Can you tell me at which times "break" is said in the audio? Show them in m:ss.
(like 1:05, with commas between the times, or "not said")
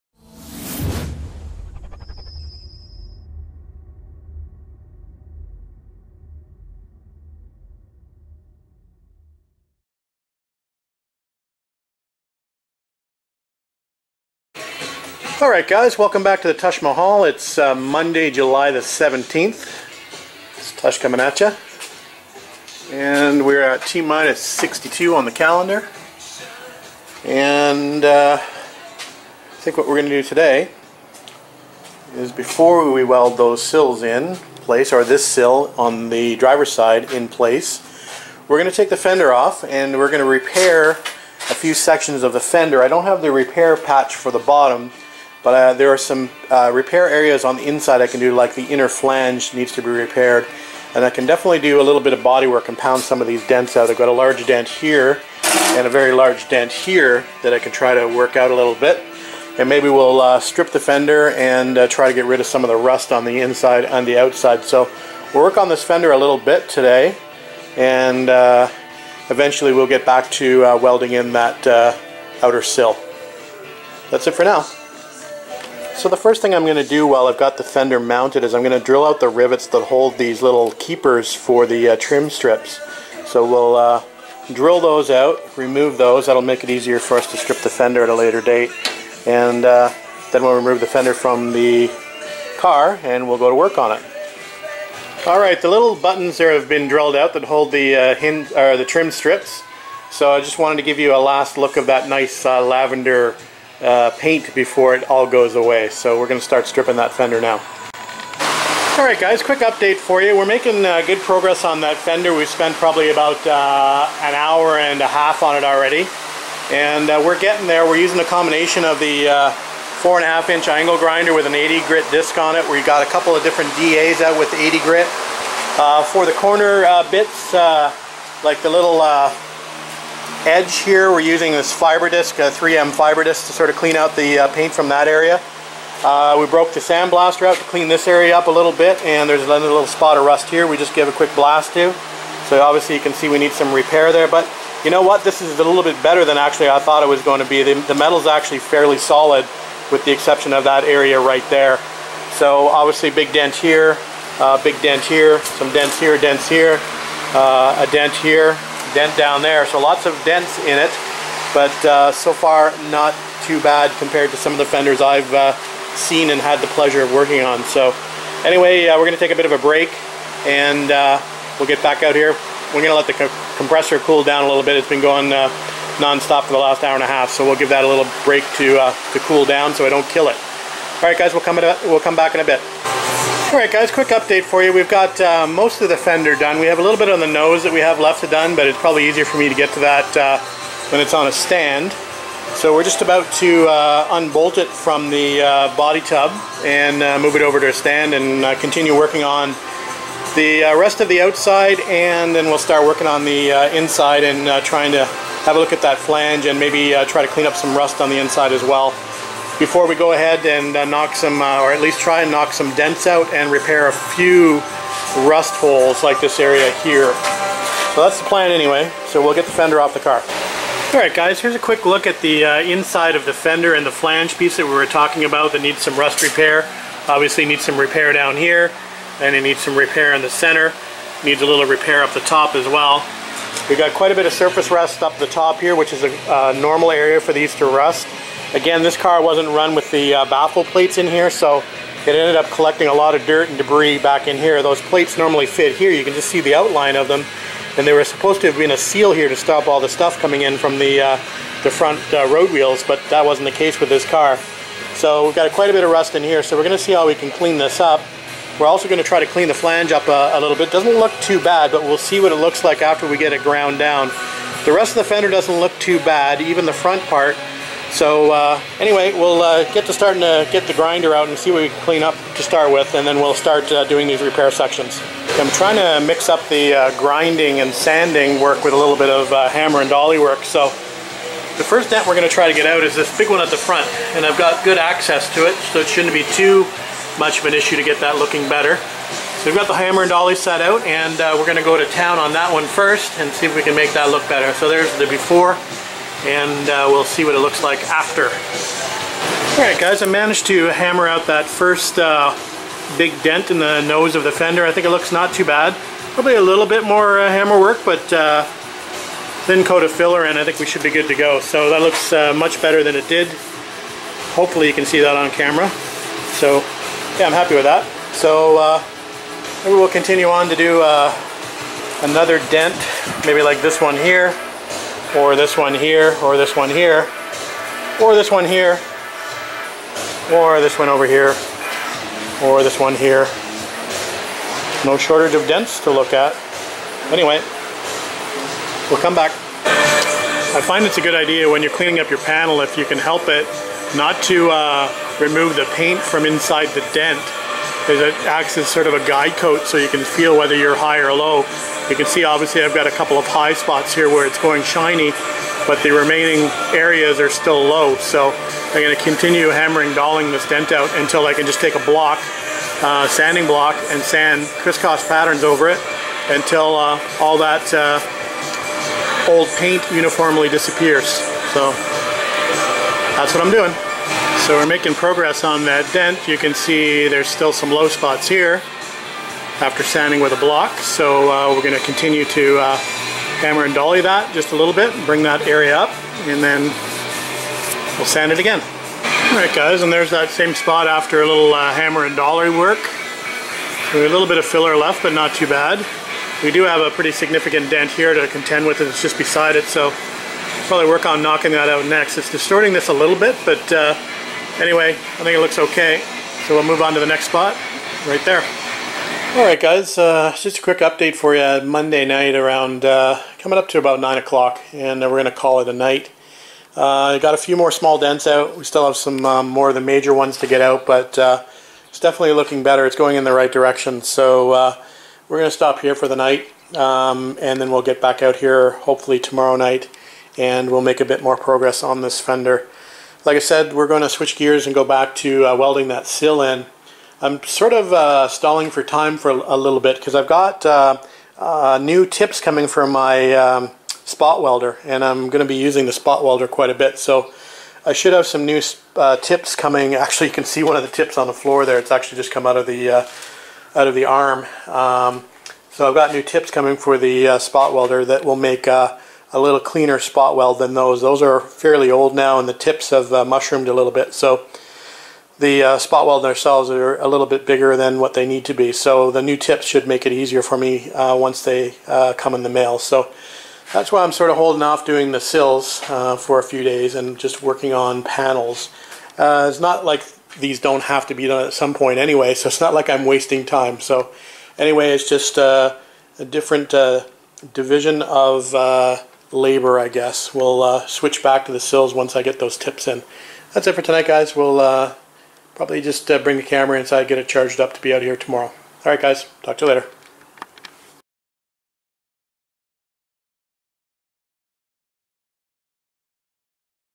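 2:49, 2:58.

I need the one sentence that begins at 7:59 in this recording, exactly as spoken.
Uh, it's not like these don't have to be done at some point anyway, so it's not like I'm wasting time.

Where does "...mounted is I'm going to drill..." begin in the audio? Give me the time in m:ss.
1:17.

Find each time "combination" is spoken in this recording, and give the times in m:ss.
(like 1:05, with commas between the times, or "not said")
1:58.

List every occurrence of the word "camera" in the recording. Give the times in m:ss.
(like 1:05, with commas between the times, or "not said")
5:15, 8:16.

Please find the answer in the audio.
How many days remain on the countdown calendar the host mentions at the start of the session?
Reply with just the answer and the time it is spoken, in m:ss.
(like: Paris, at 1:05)
62, at 0:23.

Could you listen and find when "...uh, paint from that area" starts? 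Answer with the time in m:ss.
2:14.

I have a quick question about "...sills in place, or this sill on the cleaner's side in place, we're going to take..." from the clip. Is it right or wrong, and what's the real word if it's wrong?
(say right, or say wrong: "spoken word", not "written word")
wrong: "driver", not "cleaner".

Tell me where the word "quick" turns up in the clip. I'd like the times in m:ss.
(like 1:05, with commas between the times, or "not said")
1:49, 2:21, 3:03, 3:41, 6:50.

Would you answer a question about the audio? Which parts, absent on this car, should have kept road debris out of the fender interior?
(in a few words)
Baffle plates.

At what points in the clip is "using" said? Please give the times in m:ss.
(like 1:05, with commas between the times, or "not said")
1:57, 2:11, 7:25.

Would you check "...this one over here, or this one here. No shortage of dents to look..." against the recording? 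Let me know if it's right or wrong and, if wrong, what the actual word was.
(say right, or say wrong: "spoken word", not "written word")
right.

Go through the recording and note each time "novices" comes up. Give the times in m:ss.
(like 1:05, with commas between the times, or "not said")
not said.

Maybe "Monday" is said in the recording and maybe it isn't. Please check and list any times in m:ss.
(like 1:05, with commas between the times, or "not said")
0:17, 6:51.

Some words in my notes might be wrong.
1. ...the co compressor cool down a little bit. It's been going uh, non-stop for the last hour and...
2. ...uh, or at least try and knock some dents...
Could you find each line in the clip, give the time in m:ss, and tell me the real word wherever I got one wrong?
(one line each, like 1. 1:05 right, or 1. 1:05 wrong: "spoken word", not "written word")
1. 2:53 right
2. 3:31 right.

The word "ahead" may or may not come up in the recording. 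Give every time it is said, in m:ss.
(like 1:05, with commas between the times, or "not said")
3:30.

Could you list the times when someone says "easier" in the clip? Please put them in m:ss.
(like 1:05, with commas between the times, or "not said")
1:26, 3:09, 7:50.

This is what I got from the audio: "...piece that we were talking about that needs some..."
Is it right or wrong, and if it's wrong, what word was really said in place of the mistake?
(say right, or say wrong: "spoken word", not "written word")
right.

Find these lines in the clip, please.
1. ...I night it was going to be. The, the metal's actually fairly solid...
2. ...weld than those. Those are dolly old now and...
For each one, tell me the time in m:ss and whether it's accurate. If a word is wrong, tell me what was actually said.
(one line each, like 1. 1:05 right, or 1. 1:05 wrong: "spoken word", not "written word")
1. 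2:26 wrong: "thought", not "night"
2. 7:40 wrong: "fairly", not "dolly".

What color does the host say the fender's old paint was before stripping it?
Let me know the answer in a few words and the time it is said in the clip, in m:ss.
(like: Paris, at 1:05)
Lavender, at 1:42.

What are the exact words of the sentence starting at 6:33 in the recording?
So a little bit of filler left, but not too bad.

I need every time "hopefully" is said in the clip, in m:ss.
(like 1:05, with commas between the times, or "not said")
5:14, 7:08.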